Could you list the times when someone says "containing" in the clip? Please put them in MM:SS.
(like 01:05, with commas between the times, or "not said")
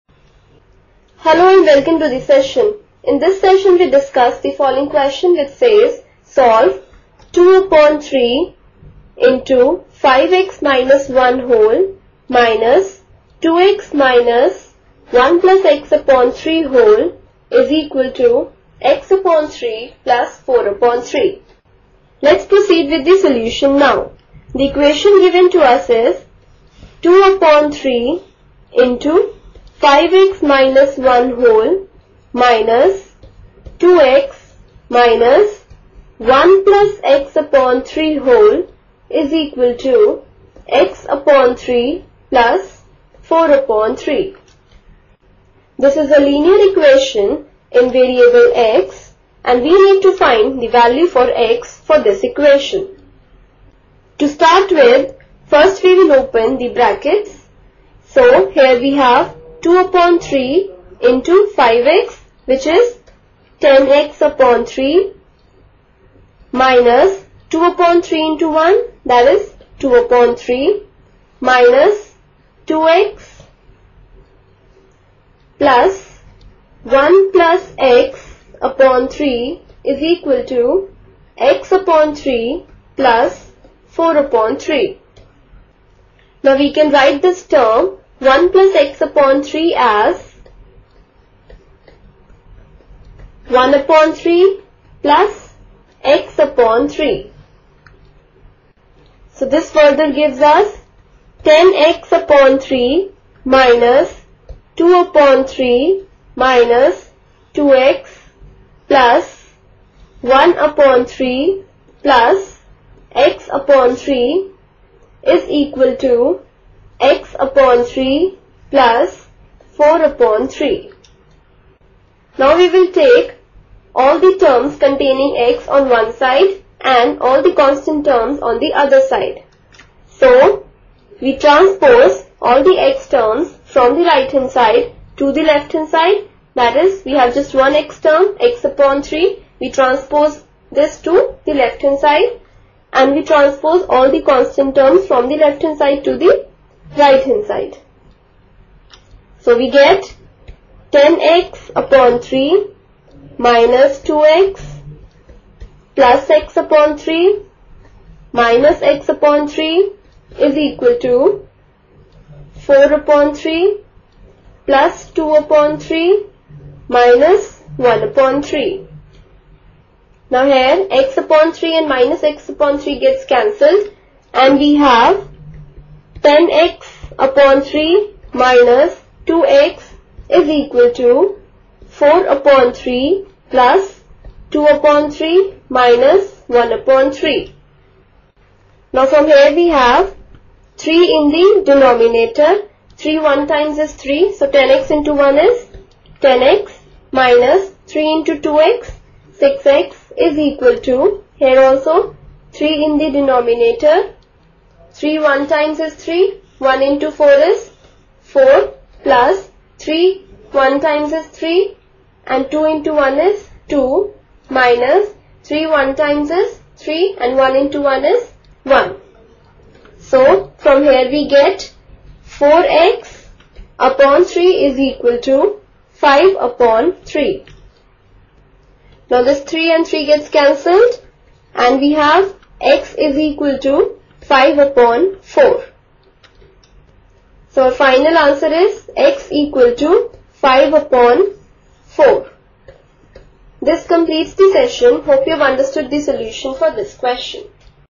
02:04.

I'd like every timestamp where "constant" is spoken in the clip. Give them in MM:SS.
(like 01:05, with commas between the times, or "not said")
02:07, 02:24.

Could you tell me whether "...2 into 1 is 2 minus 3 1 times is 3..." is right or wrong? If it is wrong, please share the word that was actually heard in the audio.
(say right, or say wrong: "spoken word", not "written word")
right.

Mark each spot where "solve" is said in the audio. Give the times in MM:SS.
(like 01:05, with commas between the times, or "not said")
00:06.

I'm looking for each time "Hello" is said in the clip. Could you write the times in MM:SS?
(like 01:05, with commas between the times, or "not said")
00:01.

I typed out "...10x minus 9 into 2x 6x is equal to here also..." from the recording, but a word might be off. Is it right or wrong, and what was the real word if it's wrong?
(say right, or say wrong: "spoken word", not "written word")
wrong: "3", not "9".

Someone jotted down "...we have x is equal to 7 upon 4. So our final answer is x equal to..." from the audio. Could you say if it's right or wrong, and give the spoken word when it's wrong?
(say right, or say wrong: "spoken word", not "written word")
wrong: "5", not "7".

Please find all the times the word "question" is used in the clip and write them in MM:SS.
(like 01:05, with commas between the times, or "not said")
00:04, 04:06.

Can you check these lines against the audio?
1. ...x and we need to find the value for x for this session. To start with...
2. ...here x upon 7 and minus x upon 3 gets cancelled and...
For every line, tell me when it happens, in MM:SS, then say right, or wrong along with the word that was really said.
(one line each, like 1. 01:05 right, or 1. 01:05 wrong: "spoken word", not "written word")
1. 00:48 wrong: "equation", not "session"
2. 02:50 wrong: "3", not "7".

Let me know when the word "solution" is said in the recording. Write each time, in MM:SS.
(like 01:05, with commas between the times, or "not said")
00:23, 04:06.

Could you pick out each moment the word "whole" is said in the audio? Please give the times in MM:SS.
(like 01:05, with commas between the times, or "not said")
00:11, 00:16, 00:31, 00:38.